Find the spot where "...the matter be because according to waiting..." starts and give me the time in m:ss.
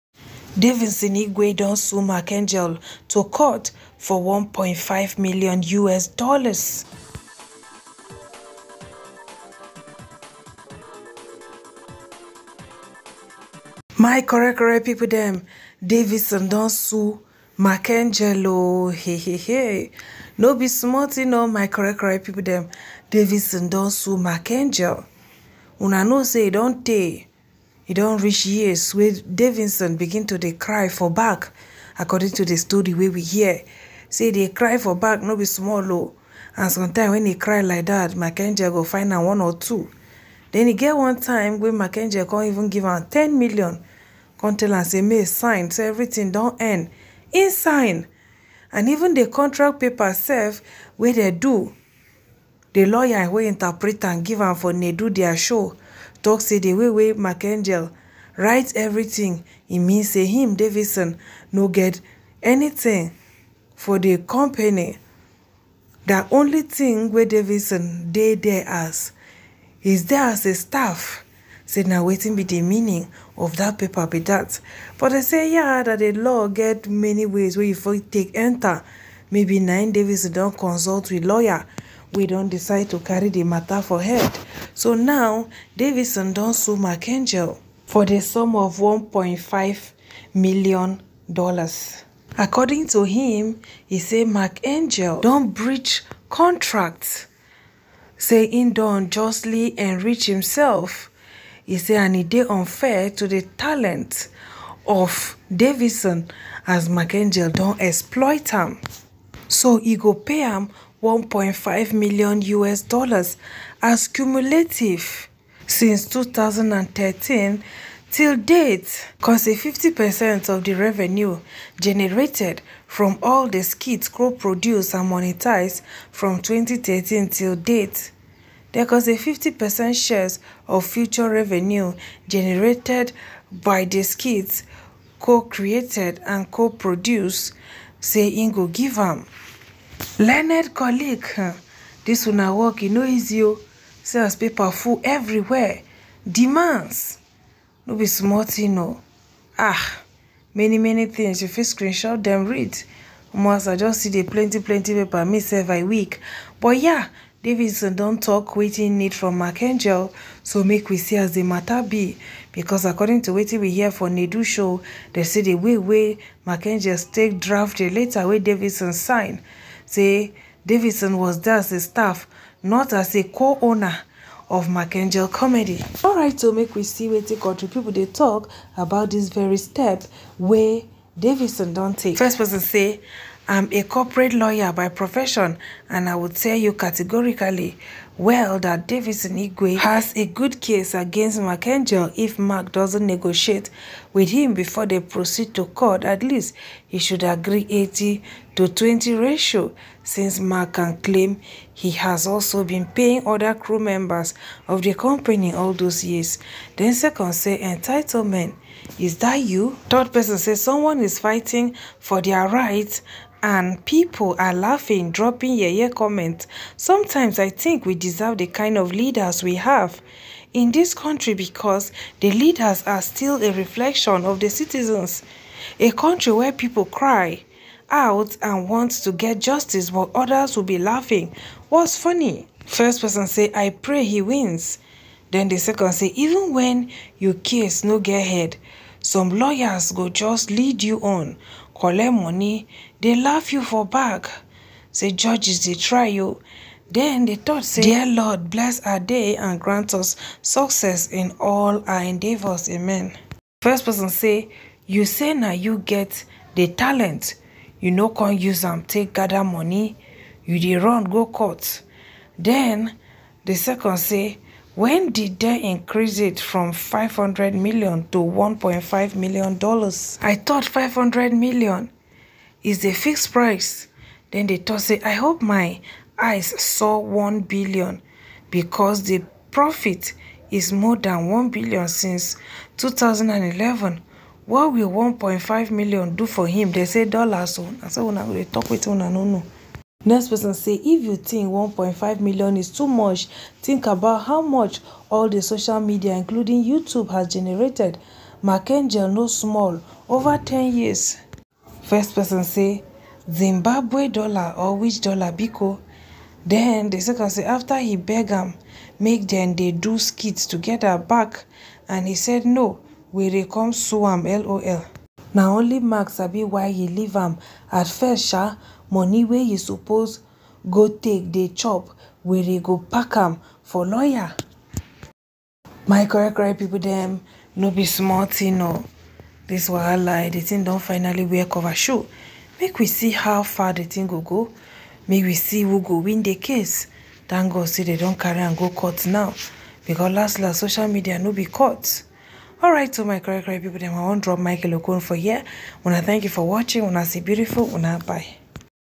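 2:41.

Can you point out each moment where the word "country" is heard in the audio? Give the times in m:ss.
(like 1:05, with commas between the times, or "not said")
2:57, 3:40, 3:45.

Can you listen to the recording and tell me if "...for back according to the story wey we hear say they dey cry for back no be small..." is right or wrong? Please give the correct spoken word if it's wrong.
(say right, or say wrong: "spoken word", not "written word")
right.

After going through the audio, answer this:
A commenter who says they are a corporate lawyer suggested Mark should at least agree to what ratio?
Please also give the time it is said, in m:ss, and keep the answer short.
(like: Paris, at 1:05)
80 to 20, at 3:17.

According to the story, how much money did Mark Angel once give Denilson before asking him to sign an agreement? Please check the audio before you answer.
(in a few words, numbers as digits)
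10 million.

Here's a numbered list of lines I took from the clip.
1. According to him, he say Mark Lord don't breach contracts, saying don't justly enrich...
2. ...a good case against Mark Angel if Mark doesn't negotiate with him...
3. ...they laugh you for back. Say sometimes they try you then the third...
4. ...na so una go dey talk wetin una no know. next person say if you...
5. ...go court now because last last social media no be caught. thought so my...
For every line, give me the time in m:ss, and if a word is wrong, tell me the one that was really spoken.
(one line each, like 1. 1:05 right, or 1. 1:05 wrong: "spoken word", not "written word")
1. 1:32 wrong: "Angel", not "Lord"
2. 3:10 right
3. 4:02 wrong: "judges", not "sometimes"
4. 4:47 right
5. 5:38 wrong: "alright", not "thought".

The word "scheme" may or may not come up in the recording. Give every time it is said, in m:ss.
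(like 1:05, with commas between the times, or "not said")
not said.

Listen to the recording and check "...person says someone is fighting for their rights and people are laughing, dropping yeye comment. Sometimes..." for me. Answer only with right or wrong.
right.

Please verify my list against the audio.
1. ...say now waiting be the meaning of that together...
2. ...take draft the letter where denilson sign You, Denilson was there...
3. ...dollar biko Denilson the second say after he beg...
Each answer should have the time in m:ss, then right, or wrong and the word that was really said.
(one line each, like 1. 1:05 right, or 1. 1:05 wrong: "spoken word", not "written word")
1. 1:11 wrong: "paper", not "together"
2. 2:46 wrong: "Say", not "You"
3. 5:05 wrong: "Then", not "Denilson".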